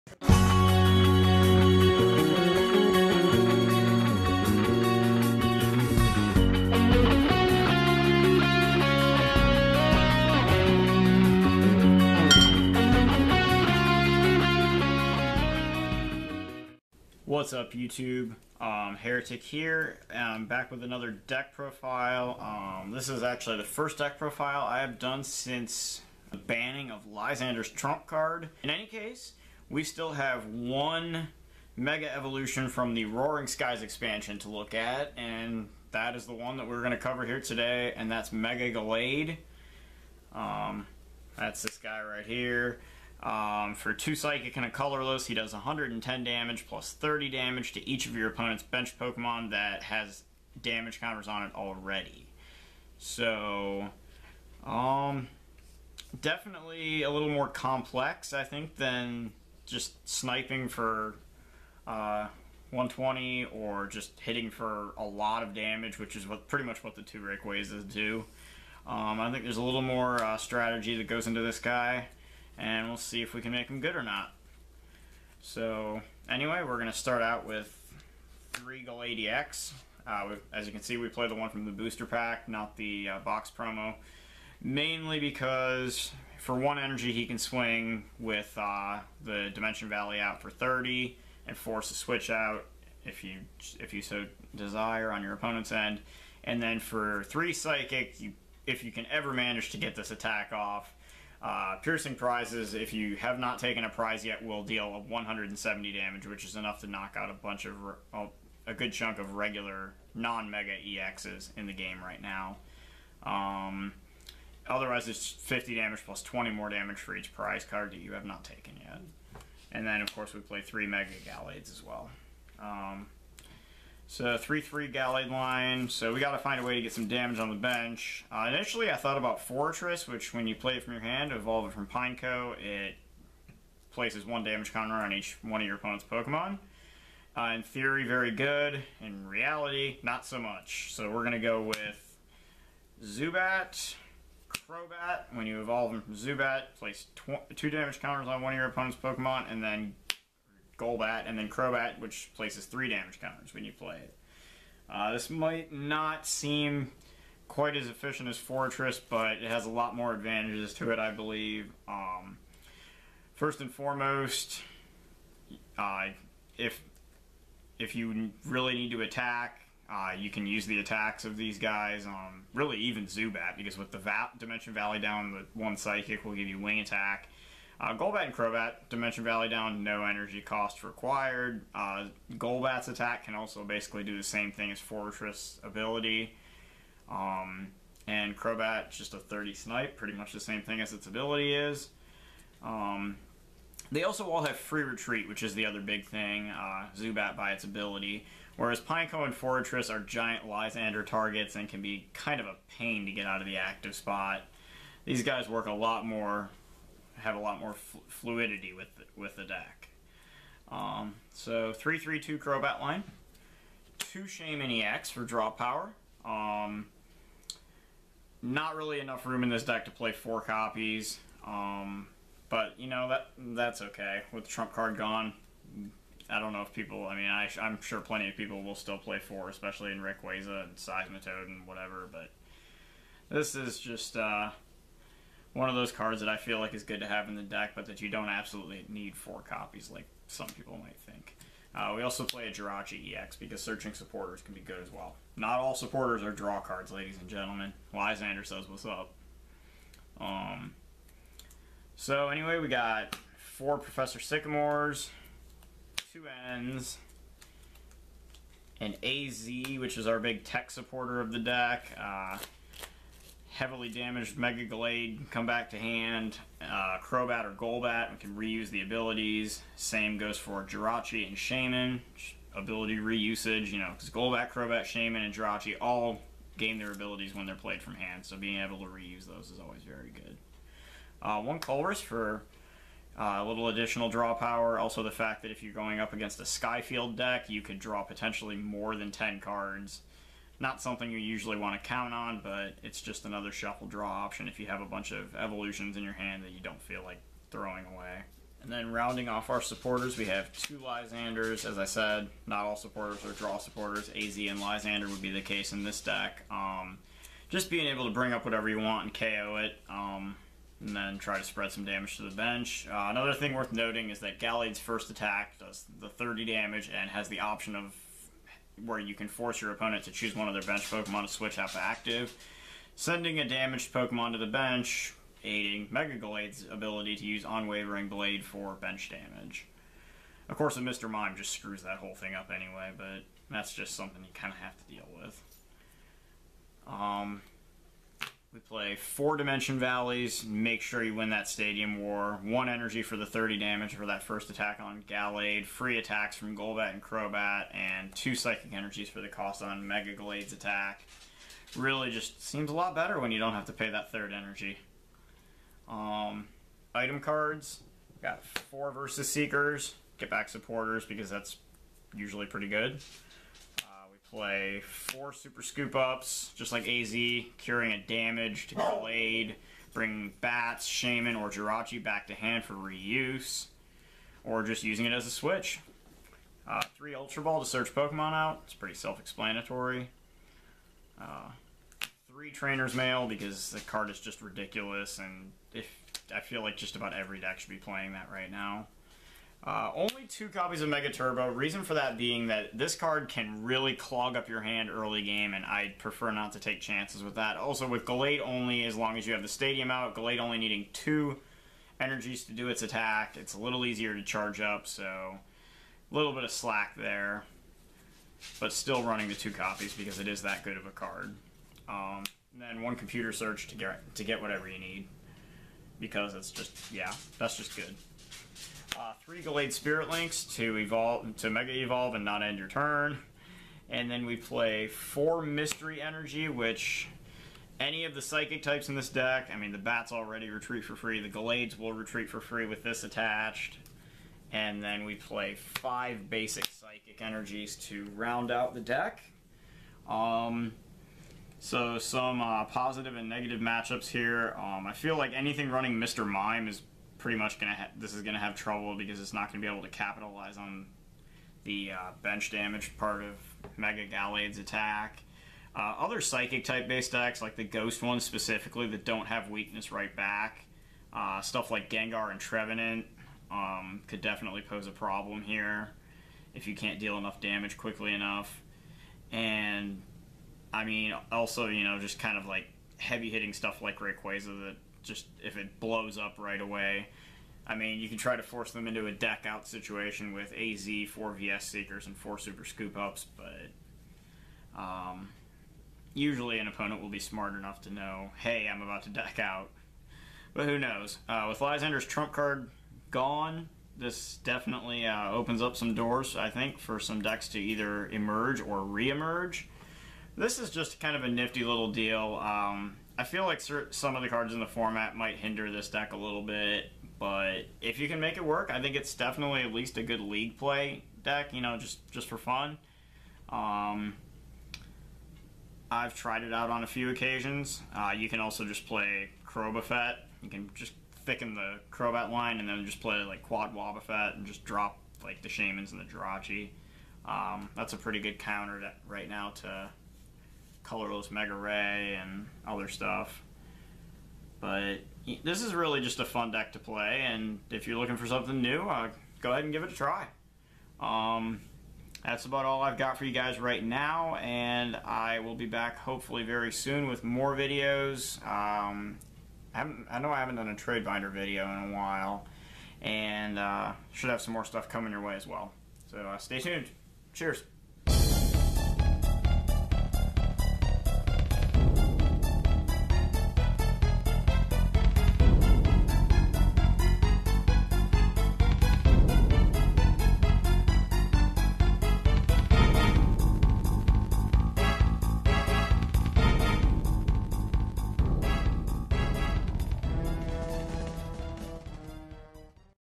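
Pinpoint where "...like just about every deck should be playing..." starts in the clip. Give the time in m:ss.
6:26.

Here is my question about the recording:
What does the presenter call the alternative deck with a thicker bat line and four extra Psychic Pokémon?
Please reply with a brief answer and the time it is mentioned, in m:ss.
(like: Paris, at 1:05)
Crobafet, at 8:39.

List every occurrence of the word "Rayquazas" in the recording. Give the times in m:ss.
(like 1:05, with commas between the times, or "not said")
1:07, 7:53.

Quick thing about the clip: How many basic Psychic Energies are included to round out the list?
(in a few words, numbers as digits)
5.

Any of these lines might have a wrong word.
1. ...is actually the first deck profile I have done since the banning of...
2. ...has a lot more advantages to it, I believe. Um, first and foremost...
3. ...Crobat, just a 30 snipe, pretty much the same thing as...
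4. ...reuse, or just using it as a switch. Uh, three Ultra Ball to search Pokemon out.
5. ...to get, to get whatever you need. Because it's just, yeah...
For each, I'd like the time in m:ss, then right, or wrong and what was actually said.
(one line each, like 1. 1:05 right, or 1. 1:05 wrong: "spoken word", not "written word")
1. 0:23 right
2. 2:39 right
3. 3:08 right
4. 6:12 right
5. 6:53 right.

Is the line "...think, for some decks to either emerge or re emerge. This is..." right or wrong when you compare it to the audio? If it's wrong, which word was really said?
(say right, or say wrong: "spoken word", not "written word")
right.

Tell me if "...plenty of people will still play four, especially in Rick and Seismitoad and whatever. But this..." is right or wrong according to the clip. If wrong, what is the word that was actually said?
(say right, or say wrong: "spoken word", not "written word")
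right.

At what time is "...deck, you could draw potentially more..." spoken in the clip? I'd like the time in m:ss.
4:47.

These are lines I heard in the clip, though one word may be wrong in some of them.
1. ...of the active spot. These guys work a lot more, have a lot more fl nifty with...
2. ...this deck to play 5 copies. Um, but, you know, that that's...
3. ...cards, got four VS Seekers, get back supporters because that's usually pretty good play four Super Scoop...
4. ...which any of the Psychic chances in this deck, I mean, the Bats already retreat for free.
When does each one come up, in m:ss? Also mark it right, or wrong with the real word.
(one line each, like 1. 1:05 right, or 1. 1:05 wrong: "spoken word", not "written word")
1. 3:23 wrong: "fluidity", not "nifty"
2. 3:39 wrong: "4", not "5"
3. 5:57 right
4. 7:06 wrong: "types", not "chances".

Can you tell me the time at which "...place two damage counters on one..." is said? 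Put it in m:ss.
2:26.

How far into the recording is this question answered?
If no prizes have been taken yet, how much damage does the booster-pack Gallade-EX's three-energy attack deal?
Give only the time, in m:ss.
1:45.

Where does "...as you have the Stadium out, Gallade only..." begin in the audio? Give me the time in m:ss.
6:39.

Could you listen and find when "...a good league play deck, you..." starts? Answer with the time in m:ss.
8:29.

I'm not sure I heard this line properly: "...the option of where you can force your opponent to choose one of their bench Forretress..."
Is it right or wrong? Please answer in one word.
wrong.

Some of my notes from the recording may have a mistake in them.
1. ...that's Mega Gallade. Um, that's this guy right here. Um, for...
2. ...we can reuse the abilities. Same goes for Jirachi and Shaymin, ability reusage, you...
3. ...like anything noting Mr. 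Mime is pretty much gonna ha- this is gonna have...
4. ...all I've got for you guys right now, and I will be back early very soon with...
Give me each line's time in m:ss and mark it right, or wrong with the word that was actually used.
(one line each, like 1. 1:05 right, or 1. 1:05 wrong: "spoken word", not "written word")
1. 0:38 right
2. 4:28 right
3. 7:25 wrong: "running", not "noting"
4. 9:02 wrong: "hopefully", not "early".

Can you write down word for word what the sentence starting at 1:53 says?
Um, Otherwise, it's 50 damage plus 20 more damage for each prize card that you have not taken yet.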